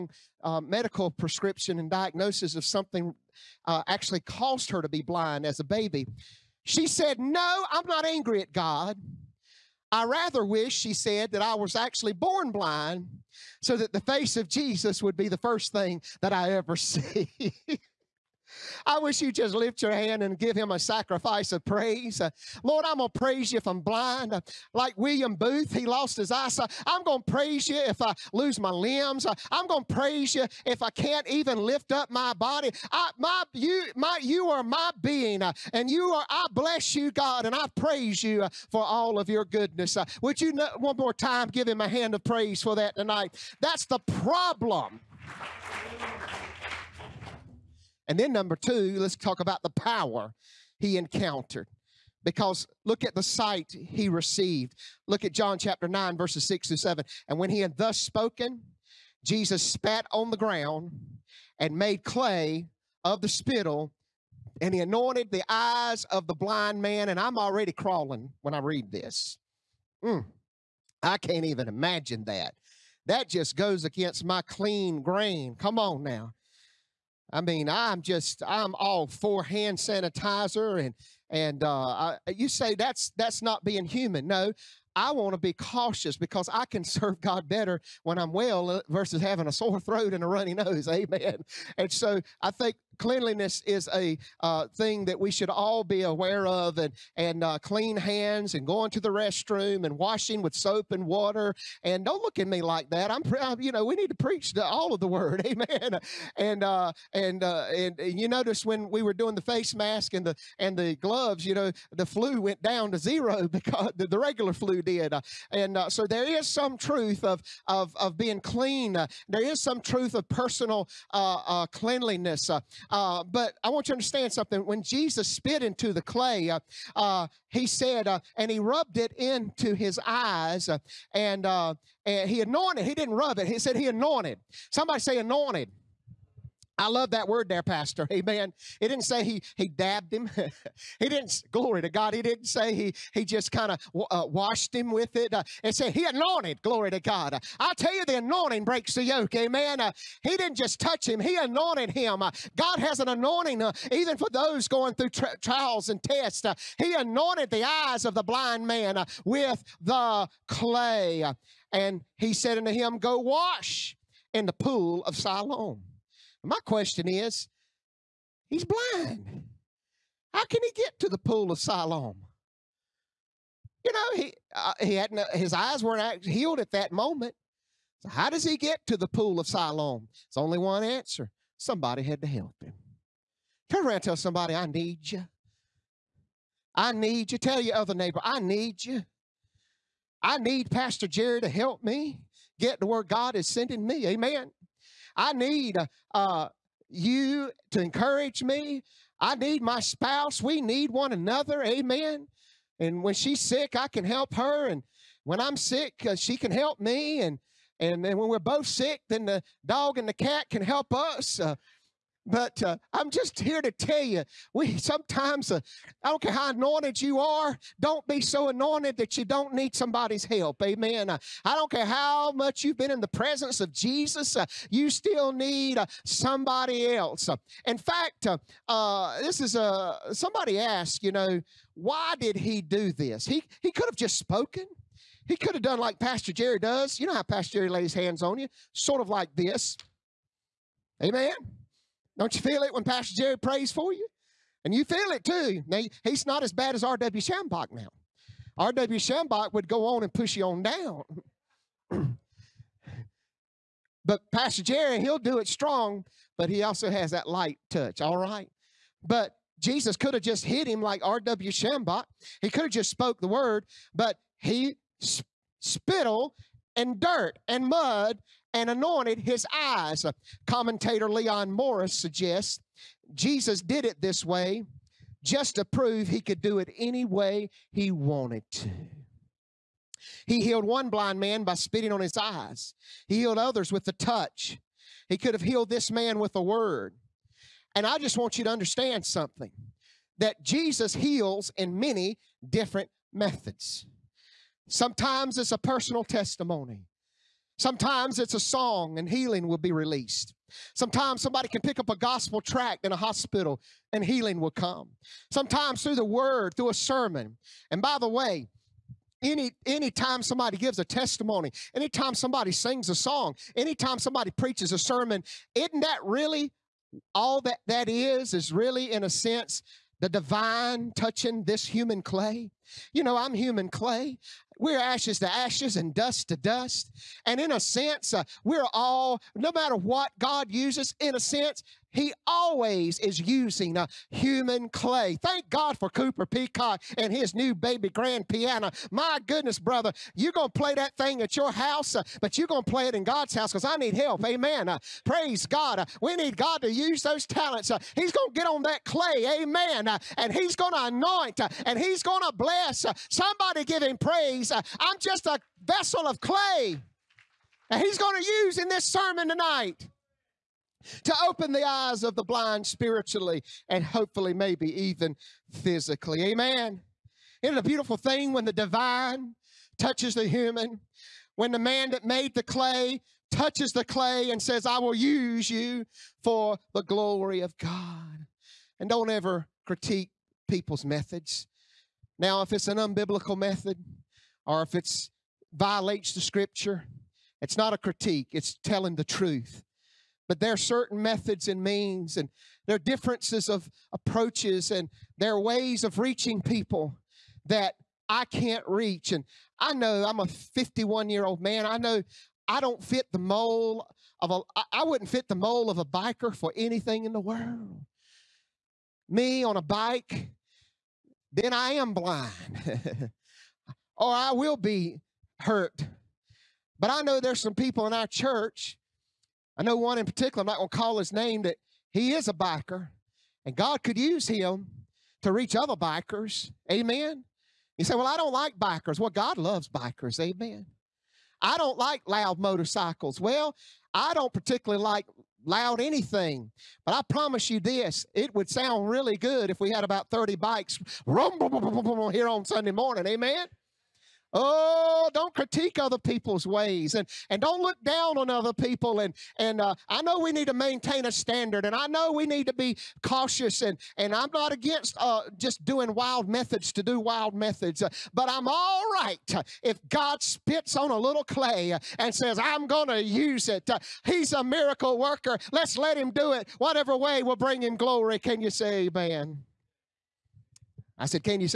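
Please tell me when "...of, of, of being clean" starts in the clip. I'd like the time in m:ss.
1:57.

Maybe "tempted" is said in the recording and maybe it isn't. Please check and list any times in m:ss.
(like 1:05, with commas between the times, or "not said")
not said.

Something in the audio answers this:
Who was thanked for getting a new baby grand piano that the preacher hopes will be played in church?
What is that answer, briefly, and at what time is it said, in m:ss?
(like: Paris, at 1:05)
Cooper Peacock, at 5:35.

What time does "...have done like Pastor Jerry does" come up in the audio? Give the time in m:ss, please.
3:55.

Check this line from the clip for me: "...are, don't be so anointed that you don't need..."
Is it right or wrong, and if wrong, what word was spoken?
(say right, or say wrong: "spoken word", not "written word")
right.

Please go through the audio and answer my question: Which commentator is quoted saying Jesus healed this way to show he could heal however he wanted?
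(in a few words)
Leon Morris.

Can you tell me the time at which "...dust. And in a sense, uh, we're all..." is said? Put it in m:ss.
5:26.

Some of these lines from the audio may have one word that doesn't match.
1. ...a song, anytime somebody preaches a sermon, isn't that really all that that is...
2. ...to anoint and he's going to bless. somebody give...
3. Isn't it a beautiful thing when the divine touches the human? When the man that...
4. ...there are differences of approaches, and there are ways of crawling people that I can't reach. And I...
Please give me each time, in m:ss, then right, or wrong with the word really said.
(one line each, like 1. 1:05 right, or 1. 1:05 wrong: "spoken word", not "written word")
1. 5:12 right
2. 5:50 right
3. 6:07 right
4. 6:32 wrong: "reaching", not "crawling".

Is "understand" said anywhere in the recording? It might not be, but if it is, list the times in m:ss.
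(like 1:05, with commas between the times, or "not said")
2:03, 4:48.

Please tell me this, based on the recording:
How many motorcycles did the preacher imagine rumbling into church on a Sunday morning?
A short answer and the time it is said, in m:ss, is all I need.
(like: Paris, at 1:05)
30, at 7:20.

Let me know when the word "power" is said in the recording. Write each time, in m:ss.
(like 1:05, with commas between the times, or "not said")
0:49.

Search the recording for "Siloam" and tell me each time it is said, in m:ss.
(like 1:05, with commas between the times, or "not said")
2:45, 2:51, 2:59.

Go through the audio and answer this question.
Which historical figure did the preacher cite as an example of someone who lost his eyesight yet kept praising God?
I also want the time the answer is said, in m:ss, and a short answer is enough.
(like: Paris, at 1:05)
William Booth, at 0:24.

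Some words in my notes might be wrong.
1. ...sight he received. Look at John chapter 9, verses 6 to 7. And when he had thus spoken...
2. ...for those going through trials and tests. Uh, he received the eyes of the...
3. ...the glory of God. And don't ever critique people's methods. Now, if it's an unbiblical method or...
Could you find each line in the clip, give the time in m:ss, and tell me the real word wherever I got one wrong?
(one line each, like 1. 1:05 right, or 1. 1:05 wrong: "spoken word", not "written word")
1. 0:53 right
2. 2:34 wrong: "anointed", not "received"
3. 6:16 right.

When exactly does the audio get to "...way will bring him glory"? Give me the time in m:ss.
7:46.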